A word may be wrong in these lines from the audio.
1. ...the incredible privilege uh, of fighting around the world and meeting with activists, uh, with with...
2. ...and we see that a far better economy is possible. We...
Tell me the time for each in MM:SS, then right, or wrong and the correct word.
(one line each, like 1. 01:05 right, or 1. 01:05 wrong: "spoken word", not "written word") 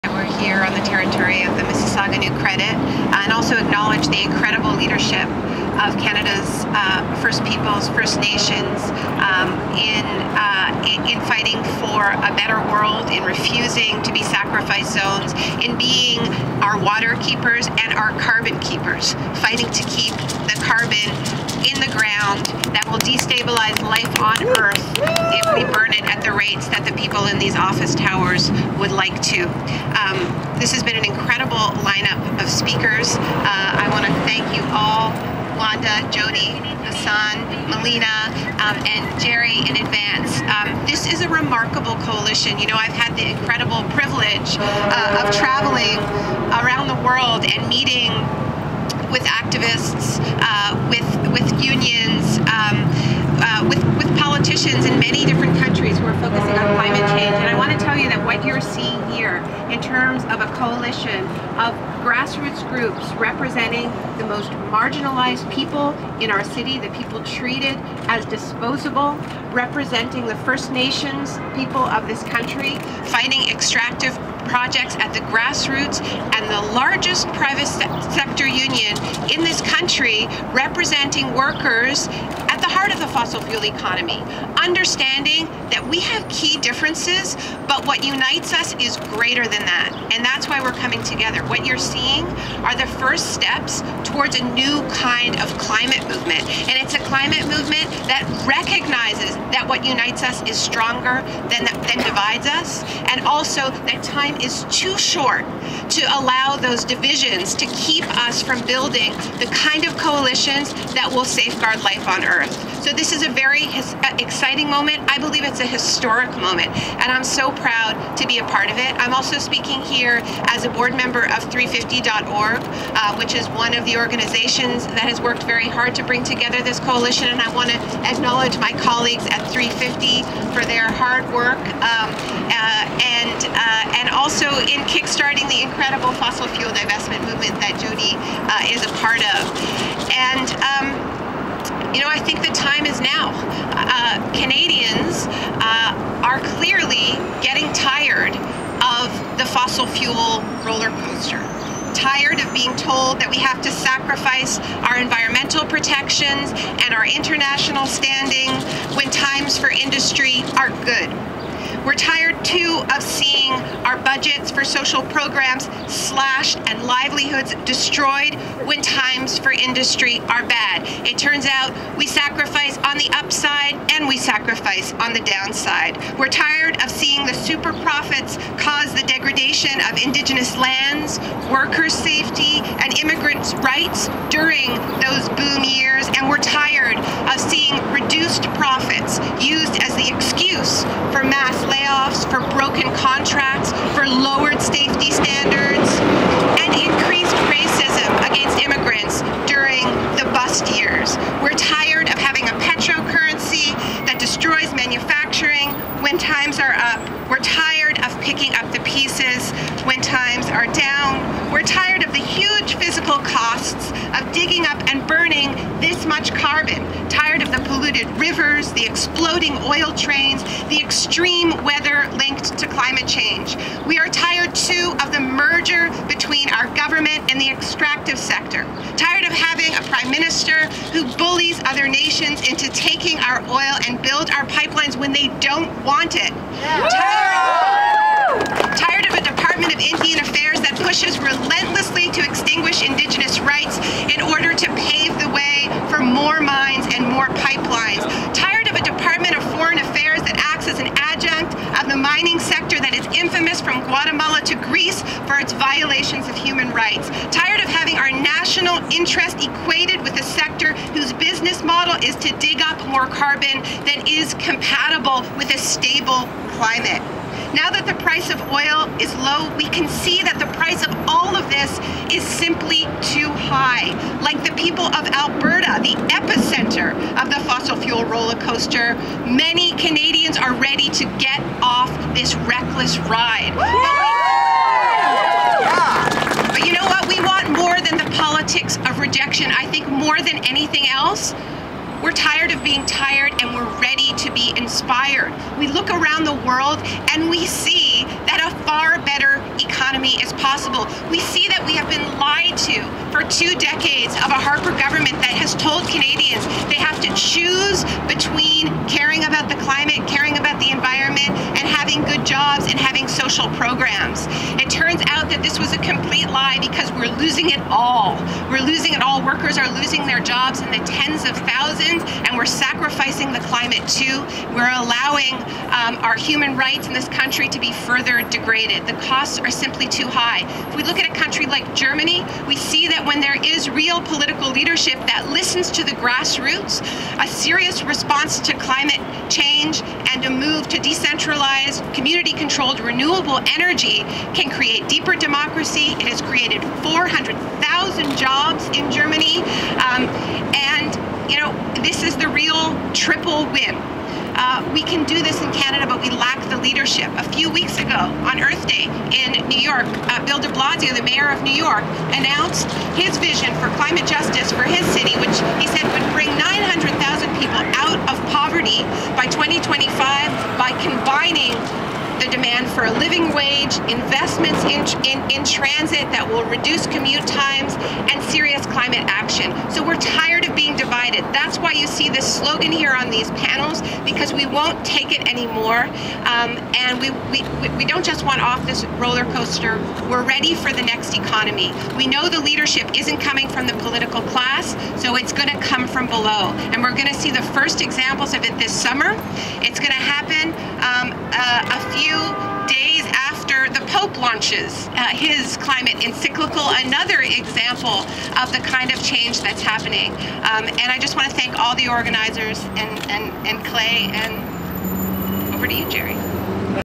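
1. 00:43 wrong: "traveling", not "fighting"
2. 04:57 right.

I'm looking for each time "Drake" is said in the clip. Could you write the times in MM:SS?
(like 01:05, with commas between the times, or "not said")
not said.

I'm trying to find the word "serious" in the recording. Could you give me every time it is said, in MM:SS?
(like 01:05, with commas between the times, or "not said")
05:37, 06:18.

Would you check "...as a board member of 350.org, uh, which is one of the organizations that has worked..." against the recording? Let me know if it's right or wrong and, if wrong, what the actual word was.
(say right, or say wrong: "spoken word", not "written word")
right.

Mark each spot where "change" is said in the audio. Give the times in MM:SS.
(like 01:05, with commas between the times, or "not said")
00:57, 03:43, 05:39, 06:49.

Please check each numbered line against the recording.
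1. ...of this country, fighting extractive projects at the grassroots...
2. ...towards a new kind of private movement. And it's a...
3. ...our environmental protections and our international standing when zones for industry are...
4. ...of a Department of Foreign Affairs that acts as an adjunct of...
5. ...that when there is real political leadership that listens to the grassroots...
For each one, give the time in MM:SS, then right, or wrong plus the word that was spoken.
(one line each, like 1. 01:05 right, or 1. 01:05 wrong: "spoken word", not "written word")
1. 01:11 right
2. 01:34 wrong: "climate", not "private"
3. 02:34 wrong: "times", not "zones"
4. 04:08 right
5. 05:32 right.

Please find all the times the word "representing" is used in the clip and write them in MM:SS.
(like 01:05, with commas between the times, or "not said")
01:03, 01:09, 01:20.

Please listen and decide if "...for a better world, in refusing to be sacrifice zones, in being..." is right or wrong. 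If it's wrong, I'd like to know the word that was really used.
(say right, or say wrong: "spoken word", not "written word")
right.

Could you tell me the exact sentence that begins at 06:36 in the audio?
And we're going to see the first examples of it this summer.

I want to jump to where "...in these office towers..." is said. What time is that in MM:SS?
00:27.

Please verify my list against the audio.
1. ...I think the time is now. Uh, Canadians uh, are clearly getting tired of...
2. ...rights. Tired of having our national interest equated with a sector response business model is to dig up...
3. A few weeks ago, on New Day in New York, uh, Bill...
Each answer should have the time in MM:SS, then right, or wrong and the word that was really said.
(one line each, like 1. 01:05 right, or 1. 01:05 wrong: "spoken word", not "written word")
1. 02:22 right
2. 04:16 wrong: "whose", not "response"
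3. 05:57 wrong: "Earth", not "New".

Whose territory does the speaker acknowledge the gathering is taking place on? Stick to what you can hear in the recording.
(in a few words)
Mississauga New Credit.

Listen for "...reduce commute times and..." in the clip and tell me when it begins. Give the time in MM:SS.
06:16.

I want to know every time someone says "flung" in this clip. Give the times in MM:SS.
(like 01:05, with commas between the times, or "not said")
not said.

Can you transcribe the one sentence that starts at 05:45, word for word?
It has created 400,000 jobs in Germany.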